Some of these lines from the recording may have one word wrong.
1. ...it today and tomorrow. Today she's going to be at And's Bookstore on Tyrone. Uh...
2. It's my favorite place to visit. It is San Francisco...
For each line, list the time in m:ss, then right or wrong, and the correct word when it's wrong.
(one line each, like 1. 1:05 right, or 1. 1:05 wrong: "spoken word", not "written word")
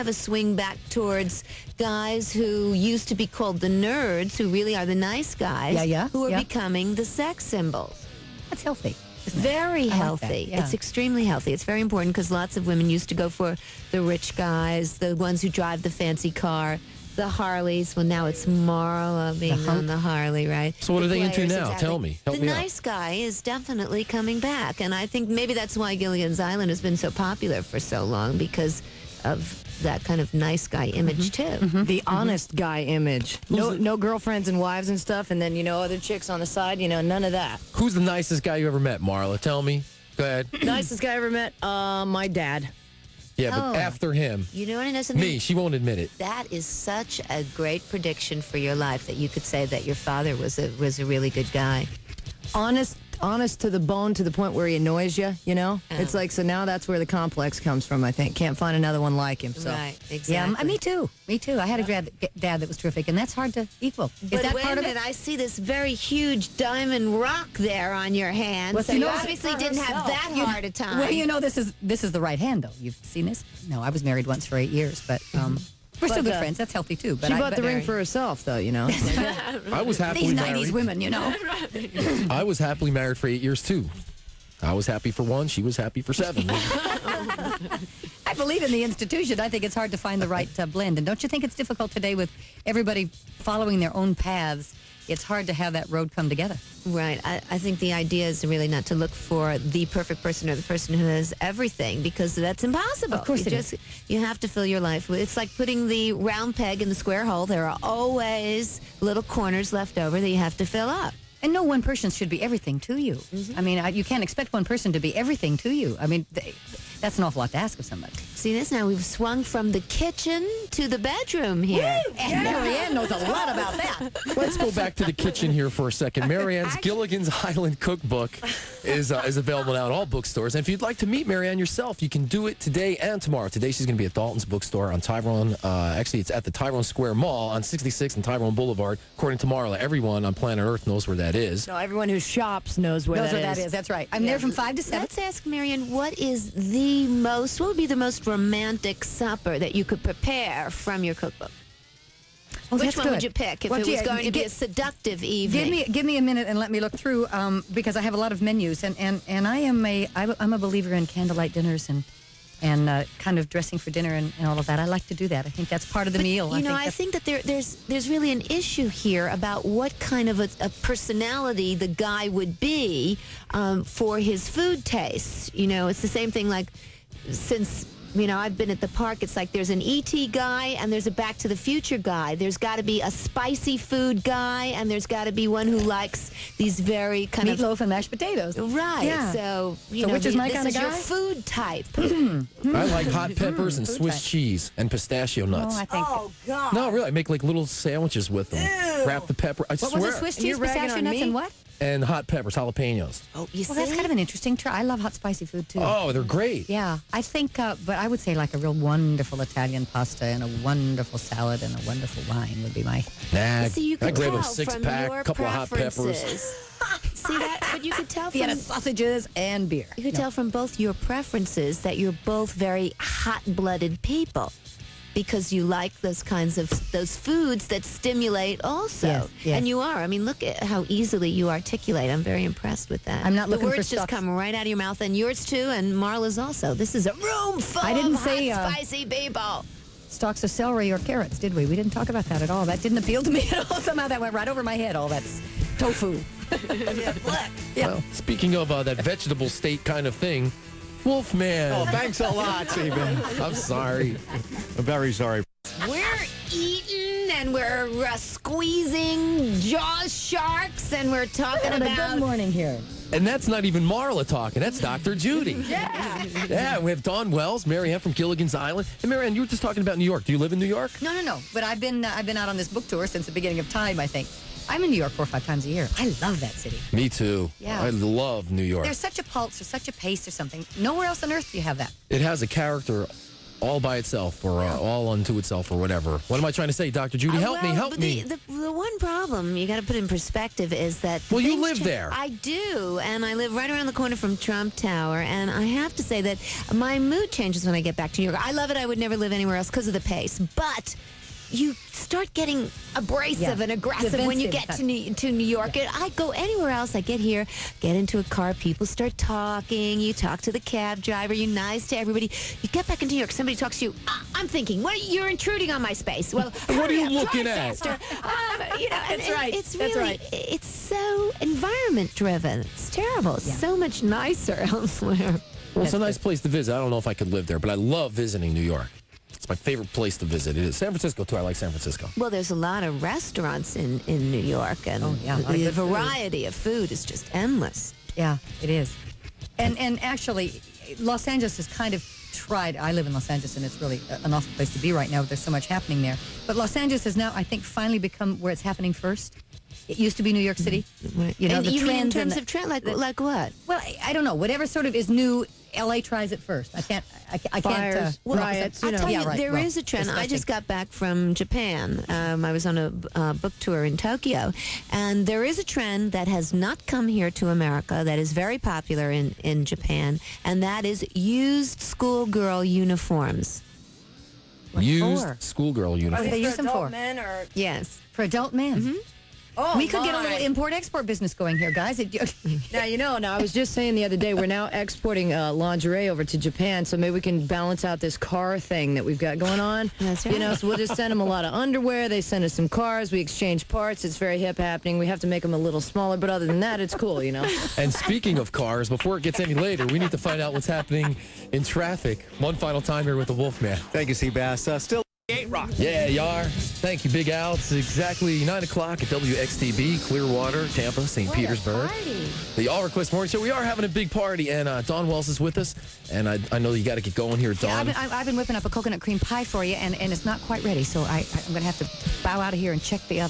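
1. 2:12 wrong: "Dalton", not "And"
2. 5:29 right.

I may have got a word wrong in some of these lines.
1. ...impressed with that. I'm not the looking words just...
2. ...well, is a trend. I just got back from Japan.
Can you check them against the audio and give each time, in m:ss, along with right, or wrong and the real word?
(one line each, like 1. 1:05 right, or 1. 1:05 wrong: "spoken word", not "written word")
1. 3:52 right
2. 5:59 right.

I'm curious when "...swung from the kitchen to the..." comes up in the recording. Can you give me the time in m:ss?
1:59.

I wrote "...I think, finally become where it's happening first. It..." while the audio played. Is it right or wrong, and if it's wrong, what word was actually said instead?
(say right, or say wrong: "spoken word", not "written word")
right.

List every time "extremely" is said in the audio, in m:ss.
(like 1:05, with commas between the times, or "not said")
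0:10.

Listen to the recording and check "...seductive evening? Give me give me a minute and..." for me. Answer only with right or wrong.
right.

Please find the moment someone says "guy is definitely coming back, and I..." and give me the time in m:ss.
0:22.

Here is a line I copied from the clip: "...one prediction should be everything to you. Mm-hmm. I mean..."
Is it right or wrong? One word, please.
wrong.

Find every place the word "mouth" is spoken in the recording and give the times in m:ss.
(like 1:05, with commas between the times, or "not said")
3:54.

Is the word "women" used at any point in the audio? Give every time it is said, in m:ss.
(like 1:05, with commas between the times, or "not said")
0:12, 1:20.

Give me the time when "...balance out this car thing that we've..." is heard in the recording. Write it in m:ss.
6:27.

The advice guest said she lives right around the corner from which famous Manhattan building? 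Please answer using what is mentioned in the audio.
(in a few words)
Trump Tower.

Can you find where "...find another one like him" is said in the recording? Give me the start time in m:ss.
0:58.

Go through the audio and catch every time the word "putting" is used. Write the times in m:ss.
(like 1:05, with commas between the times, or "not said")
1:45.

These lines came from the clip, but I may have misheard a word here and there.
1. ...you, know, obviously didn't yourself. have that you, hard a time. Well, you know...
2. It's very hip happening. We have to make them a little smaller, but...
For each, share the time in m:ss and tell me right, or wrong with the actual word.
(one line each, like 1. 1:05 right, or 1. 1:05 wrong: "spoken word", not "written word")
1. 1:08 wrong: "herself", not "yourself"
2. 6:34 right.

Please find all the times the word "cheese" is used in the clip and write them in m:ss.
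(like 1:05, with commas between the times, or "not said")
3:14, 3:20.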